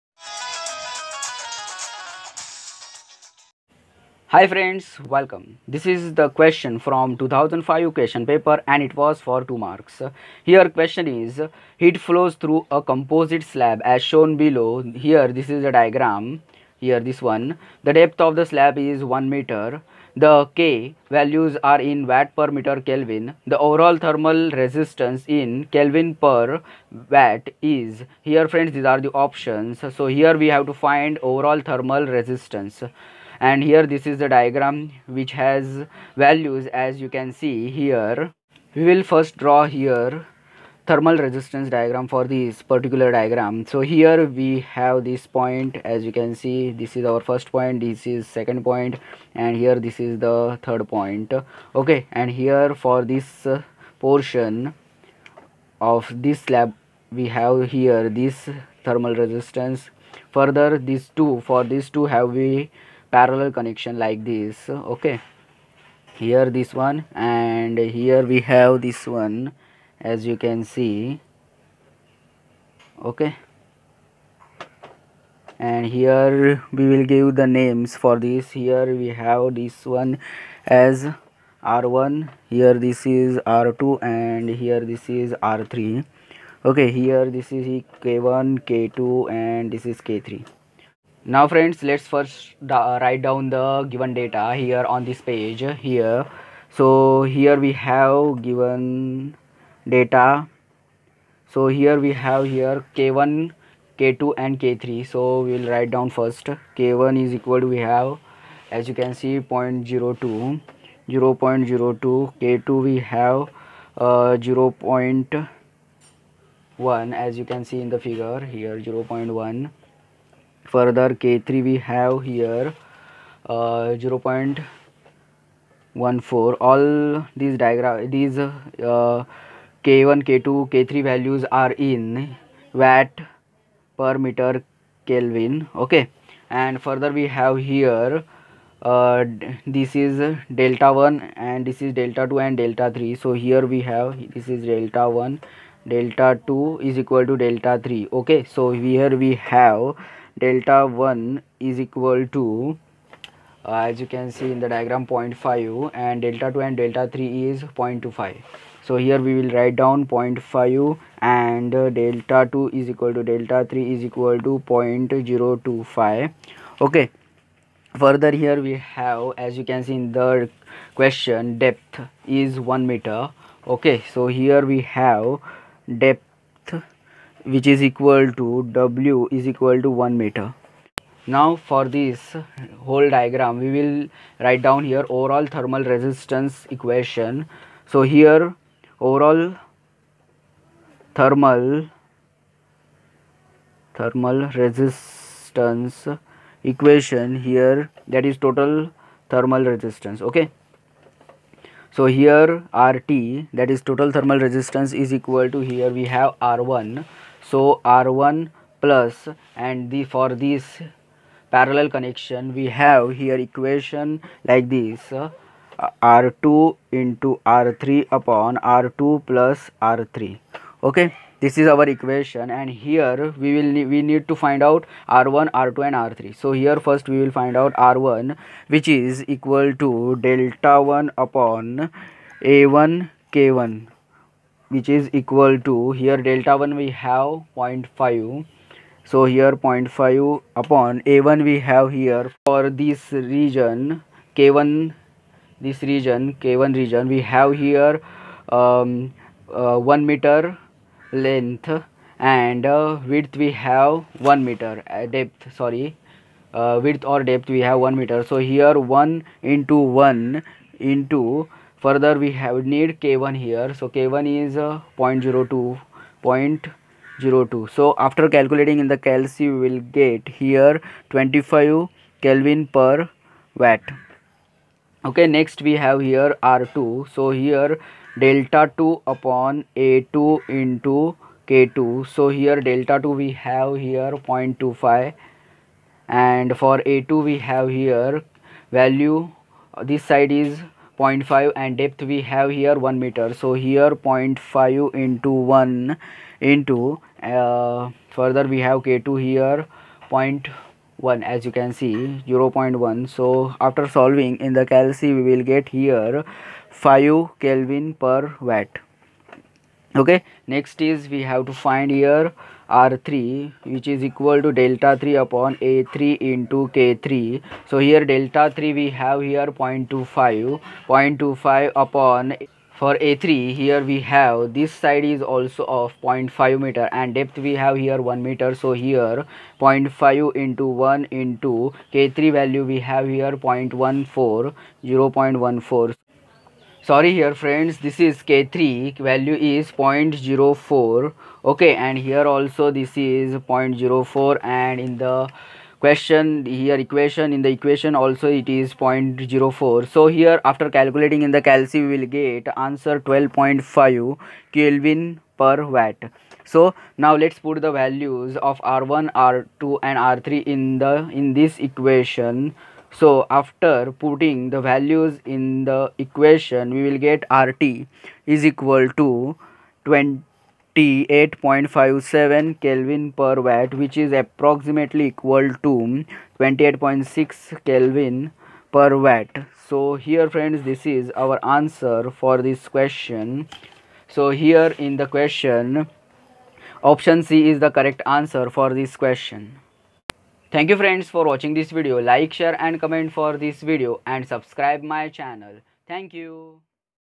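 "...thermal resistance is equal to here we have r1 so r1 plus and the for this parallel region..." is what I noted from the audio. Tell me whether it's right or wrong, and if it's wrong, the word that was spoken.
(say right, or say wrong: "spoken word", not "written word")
wrong: "connection", not "region".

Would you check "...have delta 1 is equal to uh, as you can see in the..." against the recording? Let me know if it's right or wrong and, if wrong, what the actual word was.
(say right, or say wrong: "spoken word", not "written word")
right.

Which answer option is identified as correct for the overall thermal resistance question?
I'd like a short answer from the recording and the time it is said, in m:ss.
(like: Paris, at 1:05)
Option C, at 6:26.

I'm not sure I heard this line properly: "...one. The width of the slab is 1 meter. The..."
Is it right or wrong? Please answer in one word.
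wrong.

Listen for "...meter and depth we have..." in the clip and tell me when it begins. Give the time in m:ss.
5:26.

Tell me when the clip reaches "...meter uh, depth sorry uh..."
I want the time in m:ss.
4:14.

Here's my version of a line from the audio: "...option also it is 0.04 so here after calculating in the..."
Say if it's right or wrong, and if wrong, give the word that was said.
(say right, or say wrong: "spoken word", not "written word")
wrong: "equation", not "option".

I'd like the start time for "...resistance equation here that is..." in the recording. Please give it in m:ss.
3:14.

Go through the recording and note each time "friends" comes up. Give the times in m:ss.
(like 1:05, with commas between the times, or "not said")
0:04, 0:28, 1:31, 5:37, 6:20, 6:30.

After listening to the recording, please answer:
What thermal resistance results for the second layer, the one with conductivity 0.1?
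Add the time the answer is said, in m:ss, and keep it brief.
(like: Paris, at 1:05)
5 kelvin per watt, at 5:06.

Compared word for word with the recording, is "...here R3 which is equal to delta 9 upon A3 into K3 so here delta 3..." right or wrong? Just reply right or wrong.
wrong.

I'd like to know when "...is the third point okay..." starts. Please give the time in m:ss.
0:49.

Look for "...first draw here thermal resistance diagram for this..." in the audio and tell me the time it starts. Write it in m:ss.
0:39.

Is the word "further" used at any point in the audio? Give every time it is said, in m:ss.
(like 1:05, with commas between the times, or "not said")
1:00, 2:00, 2:16, 2:48, 4:21, 4:58.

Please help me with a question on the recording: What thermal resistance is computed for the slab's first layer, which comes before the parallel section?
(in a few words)
25 kelvin per watt.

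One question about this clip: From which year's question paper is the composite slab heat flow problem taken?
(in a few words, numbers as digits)
2005.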